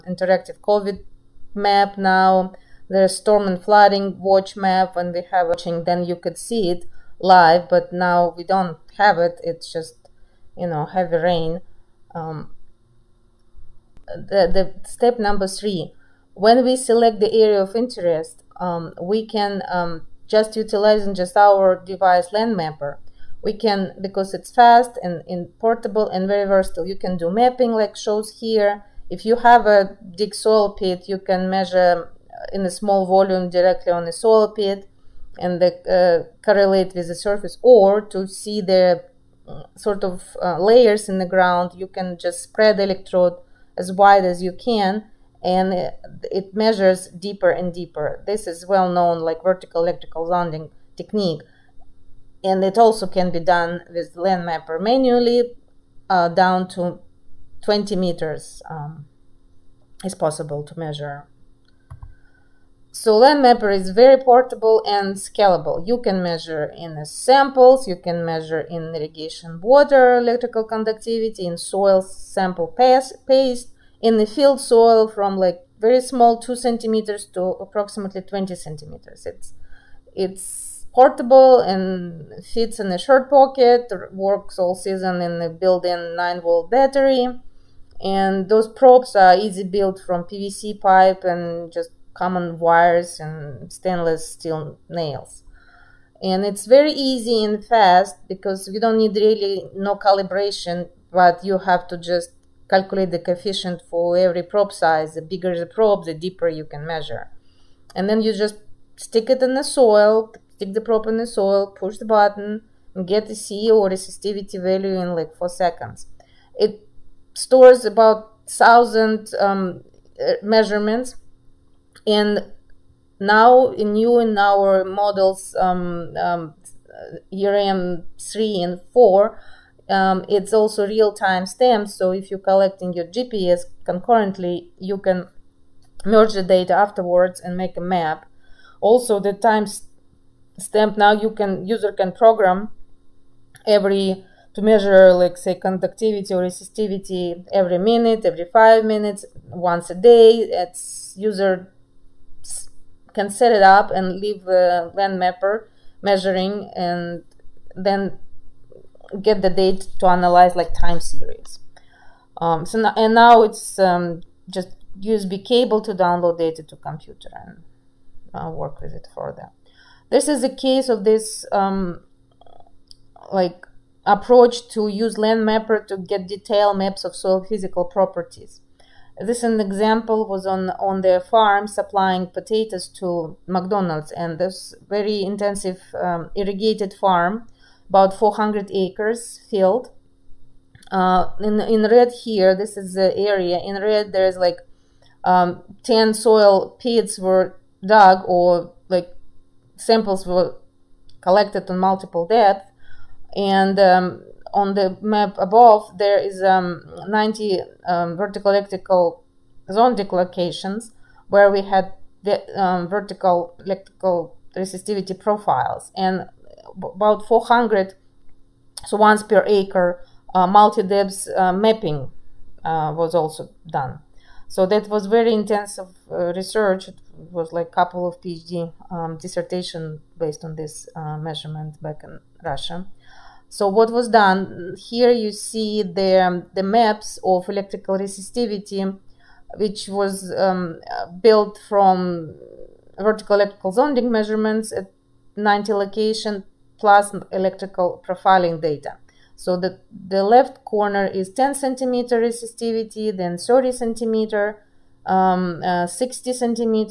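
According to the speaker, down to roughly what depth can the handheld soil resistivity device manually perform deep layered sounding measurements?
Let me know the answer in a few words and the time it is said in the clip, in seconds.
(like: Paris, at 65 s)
20 meters, at 57 s.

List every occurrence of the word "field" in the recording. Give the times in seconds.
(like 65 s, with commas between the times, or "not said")
74 s, 189 s.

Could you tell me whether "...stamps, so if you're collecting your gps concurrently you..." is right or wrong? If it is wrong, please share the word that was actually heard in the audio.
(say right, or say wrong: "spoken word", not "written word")
right.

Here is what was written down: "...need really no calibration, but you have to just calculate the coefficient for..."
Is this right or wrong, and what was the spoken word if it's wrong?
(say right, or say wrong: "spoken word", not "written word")
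right.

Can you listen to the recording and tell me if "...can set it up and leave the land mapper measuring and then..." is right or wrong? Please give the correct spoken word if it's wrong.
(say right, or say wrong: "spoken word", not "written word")
right.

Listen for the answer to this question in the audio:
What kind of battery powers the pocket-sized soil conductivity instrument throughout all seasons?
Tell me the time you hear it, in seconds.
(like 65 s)
86 s.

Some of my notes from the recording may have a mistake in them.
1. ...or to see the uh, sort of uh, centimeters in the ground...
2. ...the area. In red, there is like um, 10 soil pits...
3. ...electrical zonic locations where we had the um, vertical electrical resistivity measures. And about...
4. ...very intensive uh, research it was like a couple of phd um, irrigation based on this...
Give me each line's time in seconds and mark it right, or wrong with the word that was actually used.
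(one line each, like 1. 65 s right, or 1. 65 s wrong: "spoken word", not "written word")
1. 37 s wrong: "layers", not "centimeters"
2. 192 s right
3. 208 s wrong: "profiles", not "measures"
4. 225 s wrong: "dissertation", not "irrigation".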